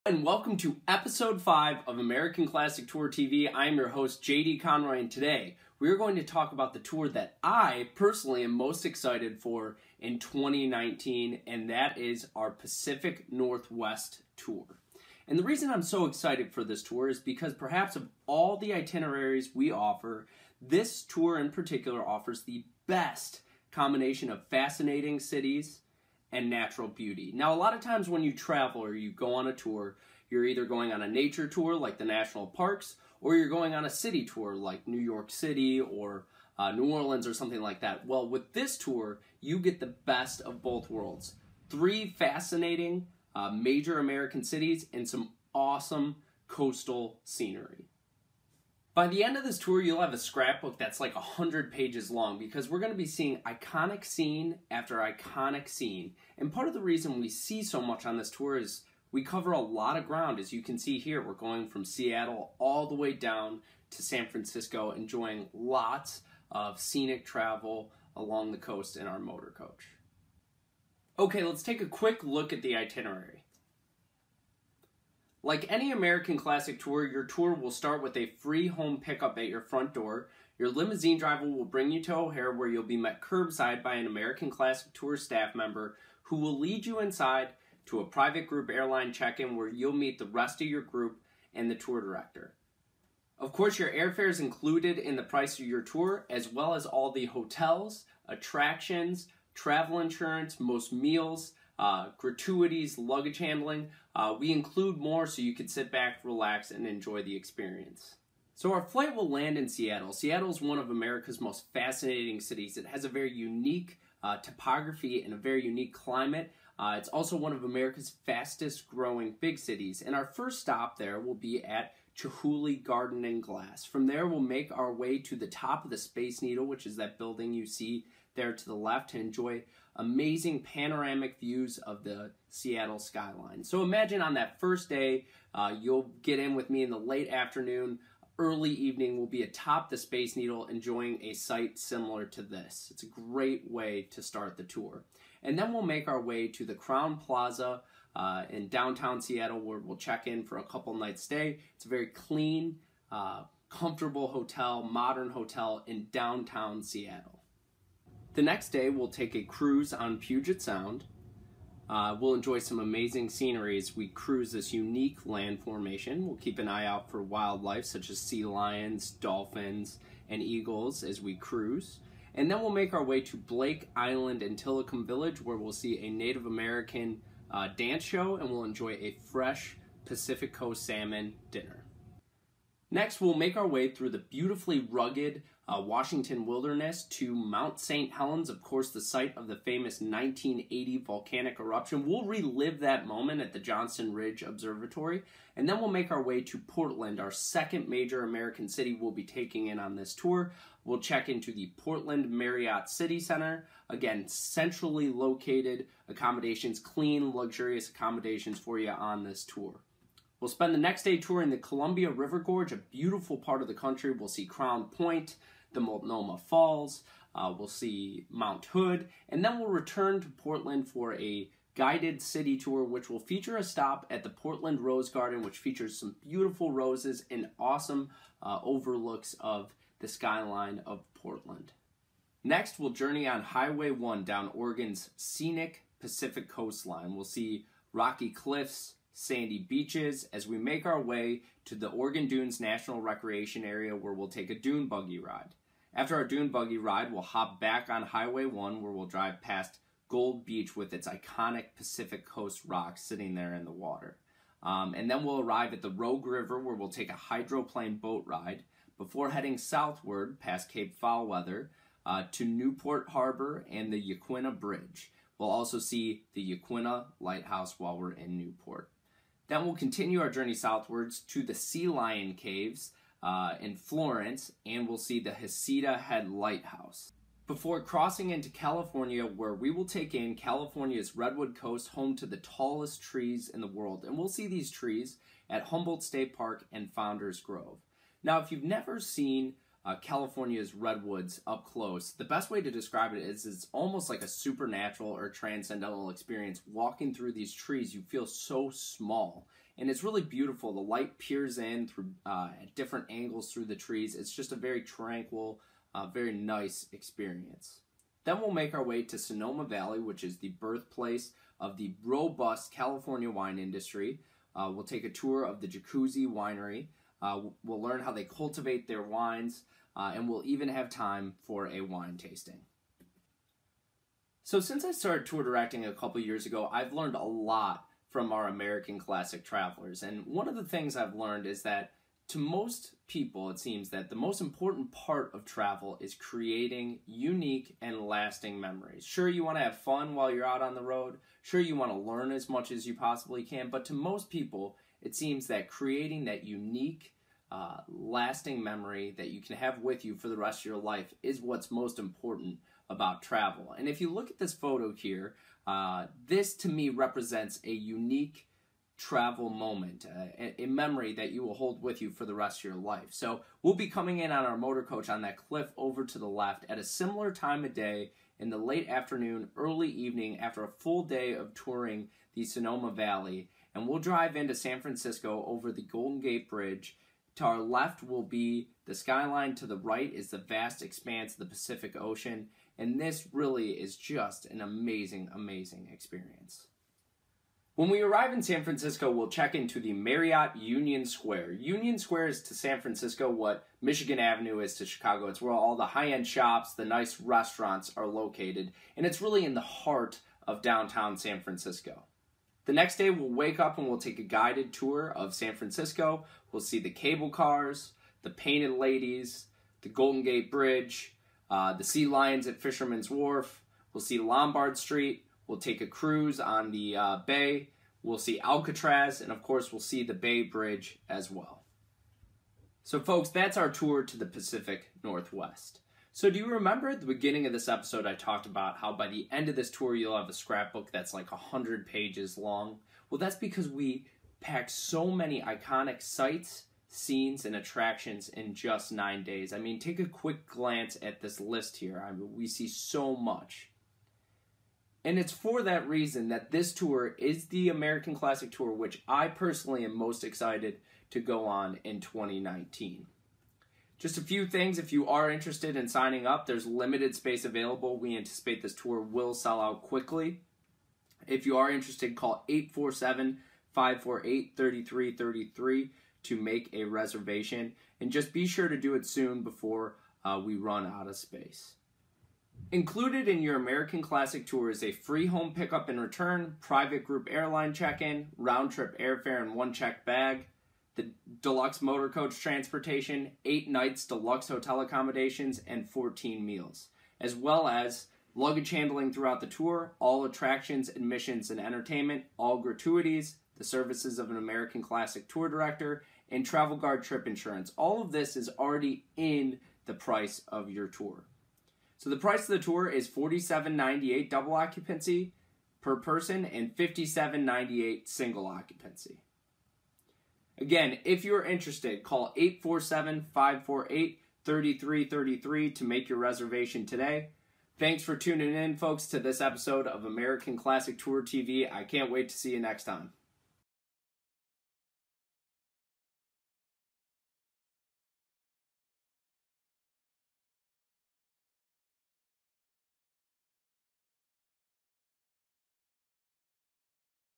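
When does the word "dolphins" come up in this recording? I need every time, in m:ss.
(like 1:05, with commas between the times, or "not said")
2:49.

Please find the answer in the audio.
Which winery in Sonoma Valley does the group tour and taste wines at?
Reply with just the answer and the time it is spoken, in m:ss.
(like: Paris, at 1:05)
Jacuzzi Winery, at 5:15.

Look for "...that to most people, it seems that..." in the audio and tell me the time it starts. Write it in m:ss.
5:31.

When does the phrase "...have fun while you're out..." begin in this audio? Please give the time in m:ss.
5:39.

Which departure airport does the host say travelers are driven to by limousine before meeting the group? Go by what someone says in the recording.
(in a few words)
O'Hare.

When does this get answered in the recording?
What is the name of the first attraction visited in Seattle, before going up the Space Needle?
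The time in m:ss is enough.
2:02.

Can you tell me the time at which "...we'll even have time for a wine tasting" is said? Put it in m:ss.
5:20.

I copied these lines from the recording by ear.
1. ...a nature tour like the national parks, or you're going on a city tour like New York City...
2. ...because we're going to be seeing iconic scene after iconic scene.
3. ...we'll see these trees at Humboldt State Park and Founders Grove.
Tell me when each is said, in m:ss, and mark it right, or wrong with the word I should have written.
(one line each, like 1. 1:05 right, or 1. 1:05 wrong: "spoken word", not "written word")
1. 0:31 right
2. 0:52 right
3. 4:44 right.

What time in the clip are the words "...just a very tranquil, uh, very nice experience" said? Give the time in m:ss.
5:04.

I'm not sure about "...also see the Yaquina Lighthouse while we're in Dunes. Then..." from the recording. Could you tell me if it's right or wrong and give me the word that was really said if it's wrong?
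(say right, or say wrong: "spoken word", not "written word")
wrong: "Newport", not "Dunes".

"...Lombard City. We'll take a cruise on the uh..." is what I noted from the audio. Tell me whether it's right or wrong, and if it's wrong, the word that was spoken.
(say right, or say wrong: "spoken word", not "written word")
wrong: "Street", not "City".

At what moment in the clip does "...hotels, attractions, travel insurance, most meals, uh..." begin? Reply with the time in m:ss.
1:37.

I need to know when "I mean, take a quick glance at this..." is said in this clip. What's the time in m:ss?
7:19.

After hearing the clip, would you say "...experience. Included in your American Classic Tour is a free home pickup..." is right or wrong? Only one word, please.
wrong.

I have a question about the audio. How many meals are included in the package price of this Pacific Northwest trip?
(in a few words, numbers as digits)
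14.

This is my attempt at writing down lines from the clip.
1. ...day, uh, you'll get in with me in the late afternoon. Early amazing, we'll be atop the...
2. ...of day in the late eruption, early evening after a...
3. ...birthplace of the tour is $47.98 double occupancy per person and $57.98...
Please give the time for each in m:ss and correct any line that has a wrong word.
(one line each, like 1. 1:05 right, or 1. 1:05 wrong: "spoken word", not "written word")
1. 2:14 wrong: "evening", not "amazing"
2. 6:07 wrong: "afternoon", not "eruption"
3. 8:22 wrong: "price", not "birthplace".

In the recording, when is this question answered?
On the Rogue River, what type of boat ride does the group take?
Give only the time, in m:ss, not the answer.
4:17.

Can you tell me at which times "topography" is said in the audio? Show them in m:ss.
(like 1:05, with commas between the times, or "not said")
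1:54.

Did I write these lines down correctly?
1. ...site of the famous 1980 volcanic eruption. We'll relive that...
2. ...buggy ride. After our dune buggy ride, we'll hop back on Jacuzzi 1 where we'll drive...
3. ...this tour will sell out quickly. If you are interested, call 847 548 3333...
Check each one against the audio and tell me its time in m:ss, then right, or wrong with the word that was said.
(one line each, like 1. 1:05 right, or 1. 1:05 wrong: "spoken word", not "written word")
1. 3:08 right
2. 4:04 wrong: "Highway", not "Jacuzzi"
3. 7:38 right.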